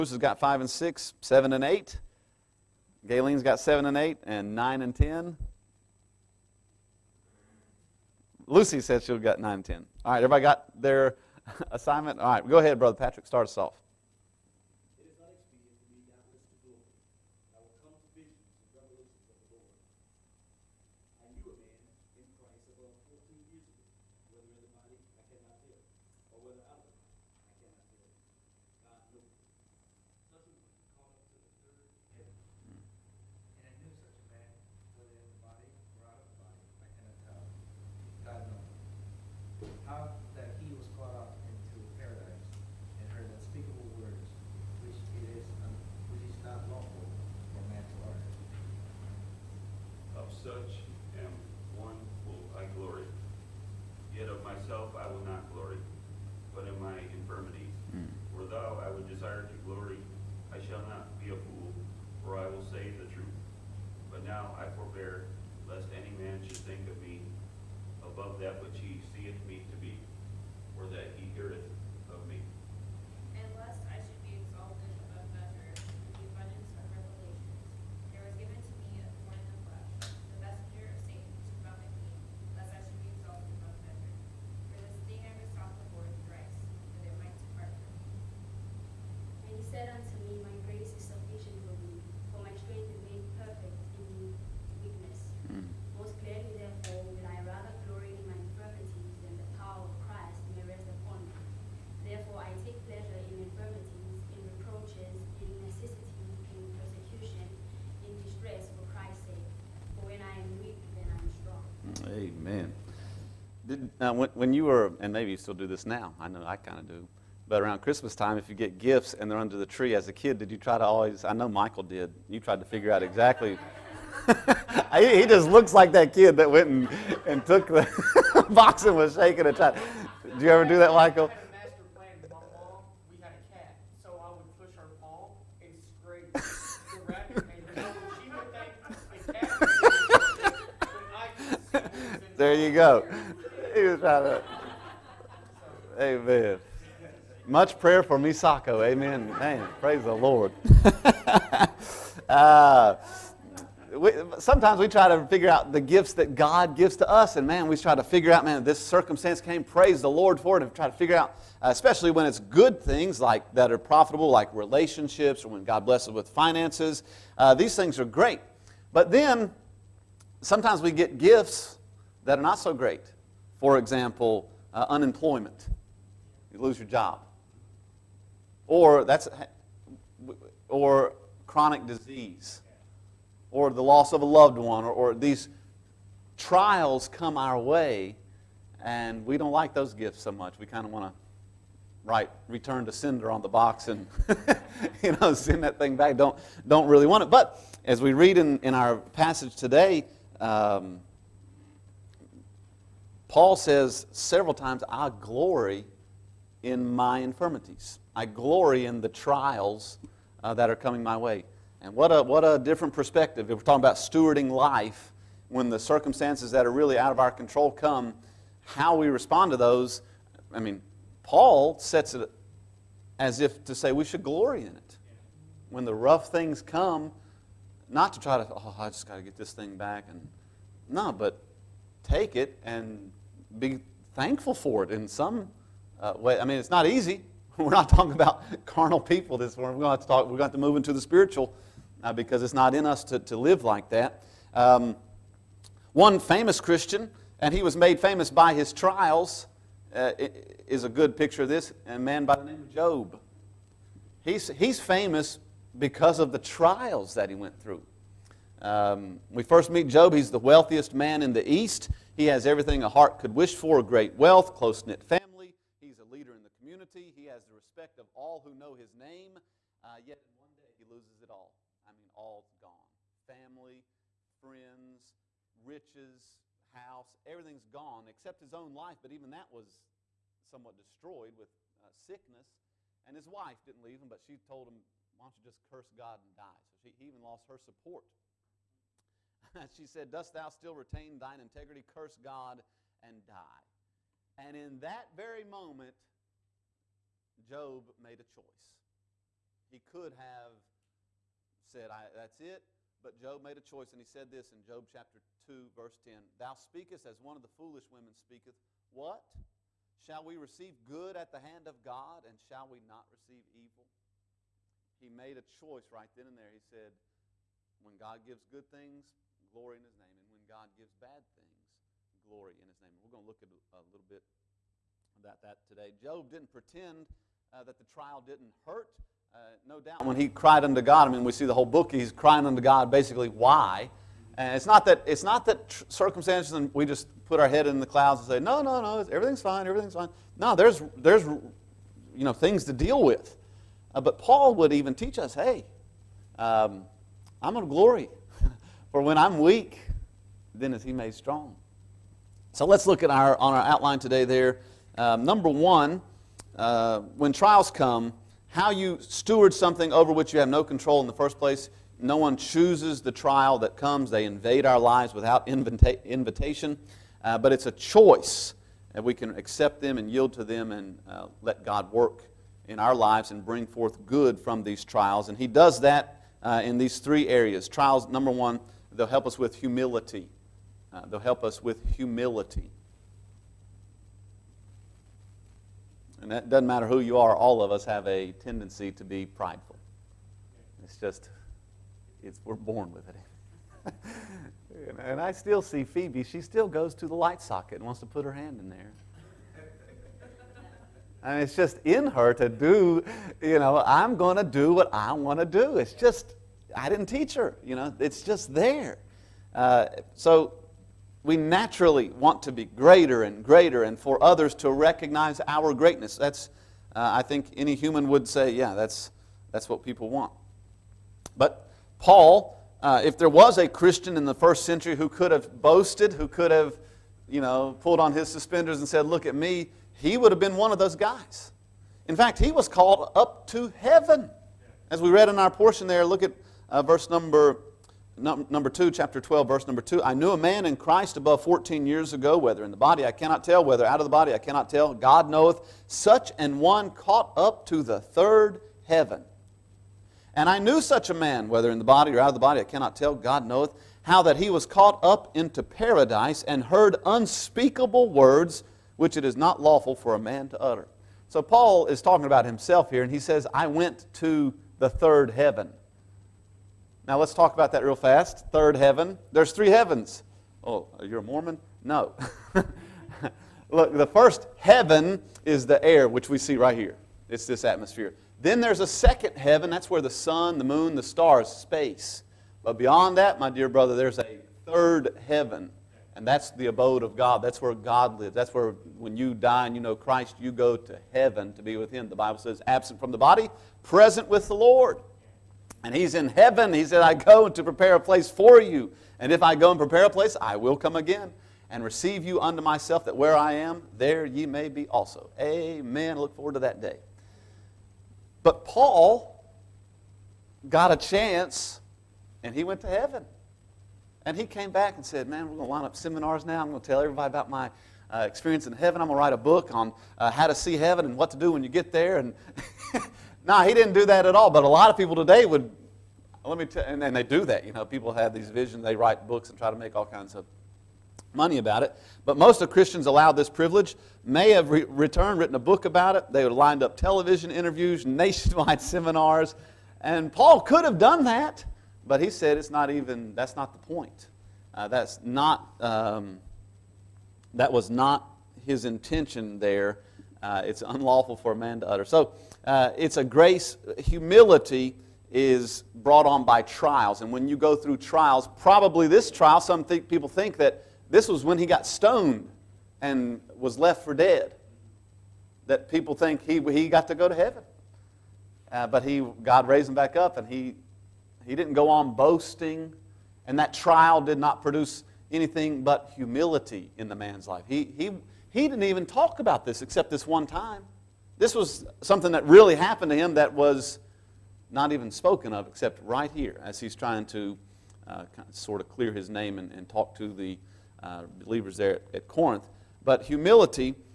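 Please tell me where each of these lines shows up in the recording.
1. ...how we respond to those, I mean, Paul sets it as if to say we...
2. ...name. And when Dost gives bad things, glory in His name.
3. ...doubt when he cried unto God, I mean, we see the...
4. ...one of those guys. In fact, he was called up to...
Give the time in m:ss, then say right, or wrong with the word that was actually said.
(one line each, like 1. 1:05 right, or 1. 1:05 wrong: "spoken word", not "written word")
1. 3:38 right
2. 5:19 wrong: "God", not "Dost"
3. 5:29 right
4. 7:10 right.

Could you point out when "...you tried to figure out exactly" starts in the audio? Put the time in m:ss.
2:02.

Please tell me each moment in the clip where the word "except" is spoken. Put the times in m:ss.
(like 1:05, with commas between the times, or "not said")
4:38, 9:39, 9:45.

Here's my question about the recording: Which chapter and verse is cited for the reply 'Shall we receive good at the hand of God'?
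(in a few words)
Chapter 2, verse 10.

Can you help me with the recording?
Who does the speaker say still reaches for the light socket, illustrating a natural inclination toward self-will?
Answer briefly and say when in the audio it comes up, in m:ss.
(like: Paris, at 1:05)
Phoebe, at 6:35.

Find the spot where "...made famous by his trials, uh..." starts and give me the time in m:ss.
4:07.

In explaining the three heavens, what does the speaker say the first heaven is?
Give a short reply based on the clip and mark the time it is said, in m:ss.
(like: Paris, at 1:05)
The air, at 7:55.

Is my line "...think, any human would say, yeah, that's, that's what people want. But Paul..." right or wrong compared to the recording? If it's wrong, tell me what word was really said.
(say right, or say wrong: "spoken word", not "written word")
right.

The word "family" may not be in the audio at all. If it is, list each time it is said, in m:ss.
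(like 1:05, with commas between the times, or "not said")
4:25, 4:33.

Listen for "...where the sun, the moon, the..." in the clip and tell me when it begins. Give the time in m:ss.
7:59.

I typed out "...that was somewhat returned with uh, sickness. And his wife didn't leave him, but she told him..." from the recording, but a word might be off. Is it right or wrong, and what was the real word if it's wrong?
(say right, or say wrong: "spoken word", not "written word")
wrong: "destroyed", not "returned".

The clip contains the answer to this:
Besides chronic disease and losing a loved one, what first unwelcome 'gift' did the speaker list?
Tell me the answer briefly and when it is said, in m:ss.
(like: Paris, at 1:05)
Unemployment, at 2:54.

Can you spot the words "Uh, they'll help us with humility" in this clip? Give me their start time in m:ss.
6:20.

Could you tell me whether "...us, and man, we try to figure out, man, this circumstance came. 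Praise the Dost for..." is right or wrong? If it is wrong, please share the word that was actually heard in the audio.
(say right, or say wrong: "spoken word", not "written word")
wrong: "Lord", not "Dost".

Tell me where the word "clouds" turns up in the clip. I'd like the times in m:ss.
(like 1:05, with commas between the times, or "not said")
5:37.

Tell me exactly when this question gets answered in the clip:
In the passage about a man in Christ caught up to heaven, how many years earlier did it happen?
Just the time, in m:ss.
7:21.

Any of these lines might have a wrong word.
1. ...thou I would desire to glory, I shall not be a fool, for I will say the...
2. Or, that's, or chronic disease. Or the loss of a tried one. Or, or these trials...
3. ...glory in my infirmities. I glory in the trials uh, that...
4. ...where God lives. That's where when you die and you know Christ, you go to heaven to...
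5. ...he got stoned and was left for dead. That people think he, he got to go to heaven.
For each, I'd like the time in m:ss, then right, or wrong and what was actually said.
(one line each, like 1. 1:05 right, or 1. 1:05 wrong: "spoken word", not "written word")
1. 0:58 right
2. 2:58 wrong: "loved", not "tried"
3. 3:25 right
4. 8:07 right
5. 9:21 right.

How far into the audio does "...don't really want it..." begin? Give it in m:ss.
3:16.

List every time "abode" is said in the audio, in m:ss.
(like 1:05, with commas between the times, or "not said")
8:06.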